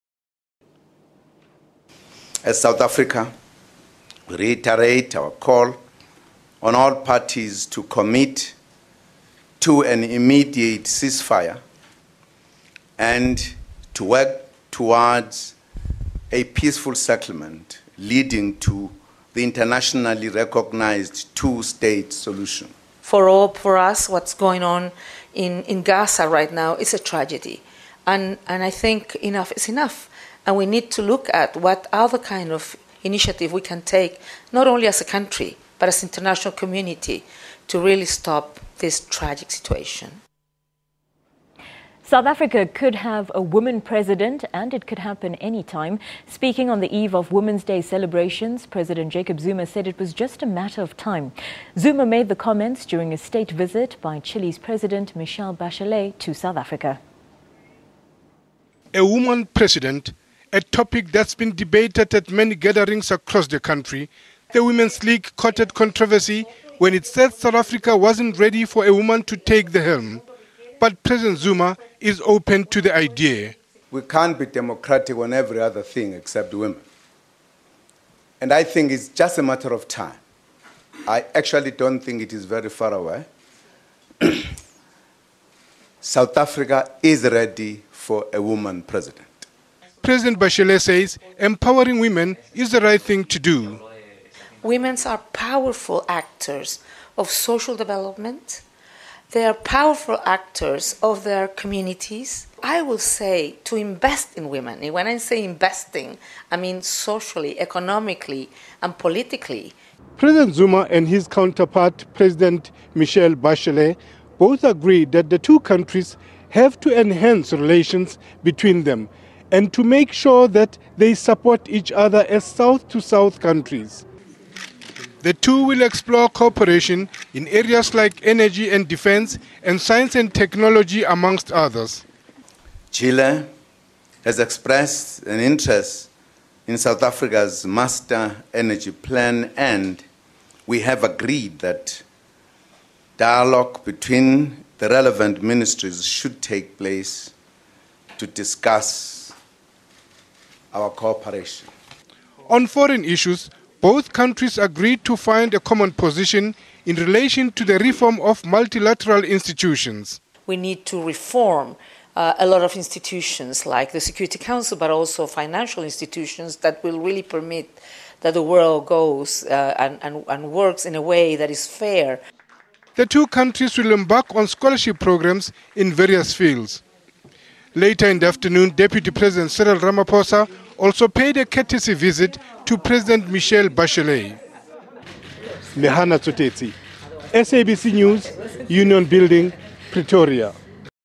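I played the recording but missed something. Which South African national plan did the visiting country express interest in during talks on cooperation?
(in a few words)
Master energy plan.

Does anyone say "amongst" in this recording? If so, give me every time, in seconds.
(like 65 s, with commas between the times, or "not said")
131 s.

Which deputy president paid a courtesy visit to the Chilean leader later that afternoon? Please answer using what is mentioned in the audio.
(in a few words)
Cyril Ramaphosa.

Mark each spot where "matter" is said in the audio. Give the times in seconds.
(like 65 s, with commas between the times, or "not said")
50 s, 79 s.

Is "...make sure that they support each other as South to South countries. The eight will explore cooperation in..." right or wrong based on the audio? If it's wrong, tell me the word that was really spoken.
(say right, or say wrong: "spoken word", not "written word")
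wrong: "two", not "eight".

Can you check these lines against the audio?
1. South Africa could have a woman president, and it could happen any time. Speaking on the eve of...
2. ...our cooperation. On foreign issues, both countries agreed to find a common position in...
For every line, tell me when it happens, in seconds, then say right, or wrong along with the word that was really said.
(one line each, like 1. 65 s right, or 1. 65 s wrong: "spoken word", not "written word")
1. 42 s right
2. 150 s right.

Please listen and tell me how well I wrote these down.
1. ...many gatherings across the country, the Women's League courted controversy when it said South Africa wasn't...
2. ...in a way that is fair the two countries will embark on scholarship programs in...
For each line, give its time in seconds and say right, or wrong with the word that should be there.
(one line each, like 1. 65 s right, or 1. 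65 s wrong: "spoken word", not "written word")
1. 62 s right
2. 170 s right.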